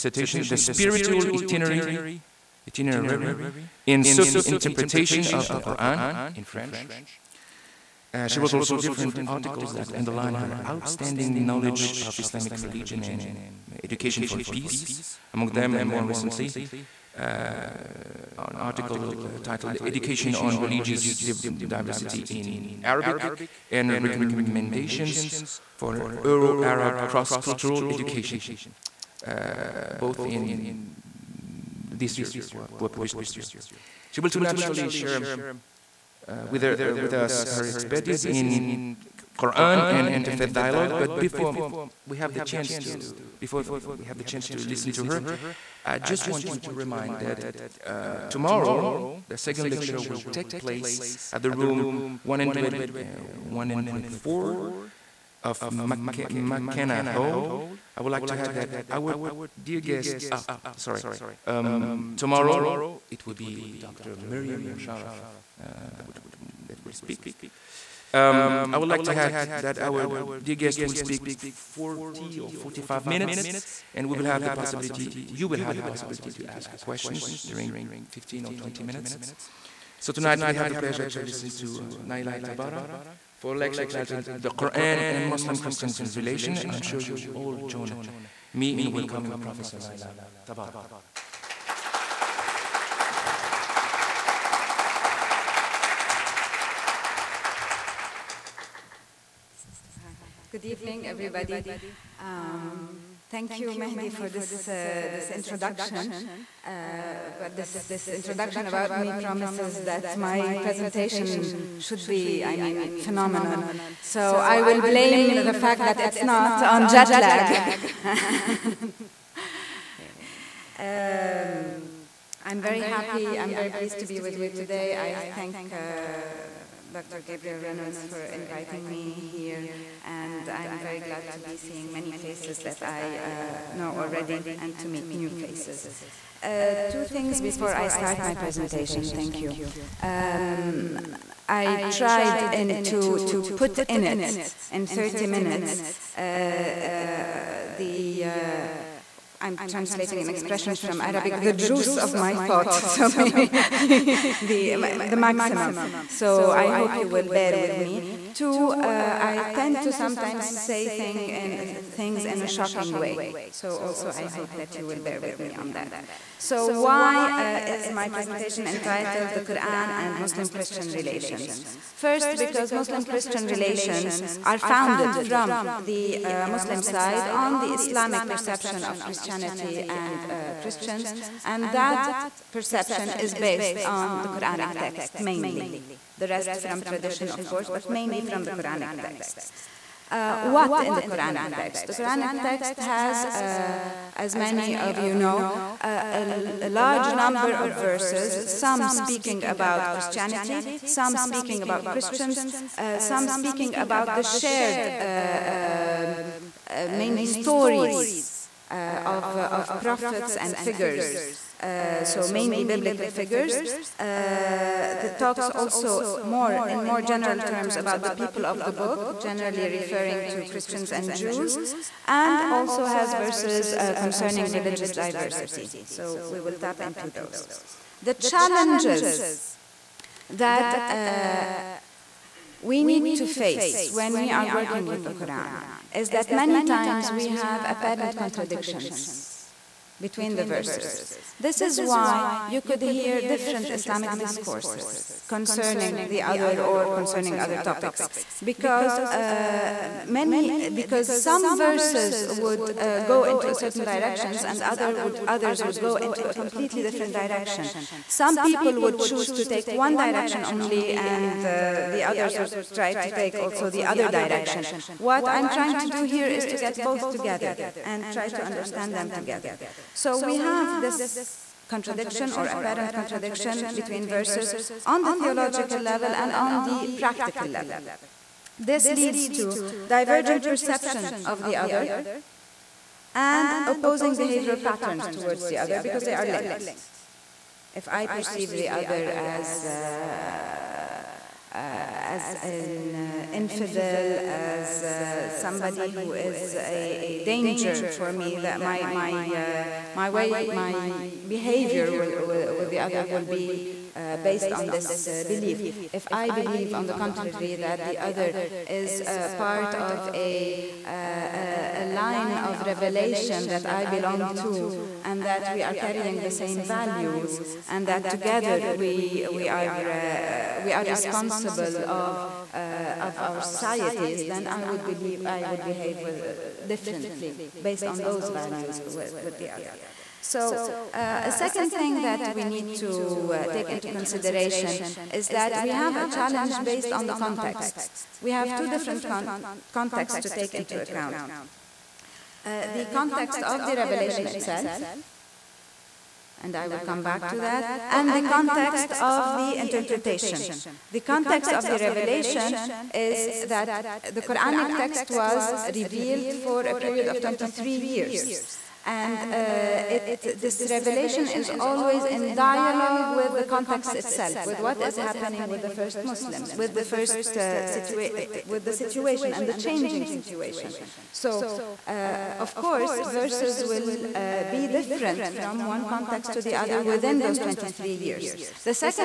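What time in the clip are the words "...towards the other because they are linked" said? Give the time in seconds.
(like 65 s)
285 s.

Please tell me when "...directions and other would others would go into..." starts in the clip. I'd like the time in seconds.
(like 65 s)
253 s.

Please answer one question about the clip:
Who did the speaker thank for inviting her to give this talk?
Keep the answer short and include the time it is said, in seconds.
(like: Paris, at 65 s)
Dr. Gabriel Reynolds, at 126 s.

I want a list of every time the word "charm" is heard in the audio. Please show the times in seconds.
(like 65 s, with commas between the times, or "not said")
not said.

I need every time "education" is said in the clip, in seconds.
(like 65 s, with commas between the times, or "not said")
13 s, 19 s, 27 s.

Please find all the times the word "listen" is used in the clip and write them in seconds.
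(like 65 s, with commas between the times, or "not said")
44 s, 81 s.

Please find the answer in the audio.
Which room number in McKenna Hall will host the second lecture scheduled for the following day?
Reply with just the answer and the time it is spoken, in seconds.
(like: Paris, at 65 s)
104, at 53 s.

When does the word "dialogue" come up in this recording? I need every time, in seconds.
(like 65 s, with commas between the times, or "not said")
40 s, 362 s.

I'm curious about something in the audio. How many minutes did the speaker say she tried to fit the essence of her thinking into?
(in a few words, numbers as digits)
30.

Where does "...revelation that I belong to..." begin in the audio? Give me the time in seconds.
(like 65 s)
312 s.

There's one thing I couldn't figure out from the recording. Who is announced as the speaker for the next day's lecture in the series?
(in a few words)
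Dr. Miriam Musharraf.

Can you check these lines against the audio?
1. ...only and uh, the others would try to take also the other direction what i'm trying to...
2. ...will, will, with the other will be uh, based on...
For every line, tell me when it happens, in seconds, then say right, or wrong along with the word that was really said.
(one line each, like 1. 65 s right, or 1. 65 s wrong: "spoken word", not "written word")
1. 260 s right
2. 301 s right.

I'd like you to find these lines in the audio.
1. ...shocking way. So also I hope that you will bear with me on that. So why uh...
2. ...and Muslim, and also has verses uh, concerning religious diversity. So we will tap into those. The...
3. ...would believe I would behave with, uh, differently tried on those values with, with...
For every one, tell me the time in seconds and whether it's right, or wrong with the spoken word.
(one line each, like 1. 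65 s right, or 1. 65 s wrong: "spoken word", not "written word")
1. 162 s right
2. 220 s wrong: "Jews", not "Muslim"
3. 324 s wrong: "based", not "tried".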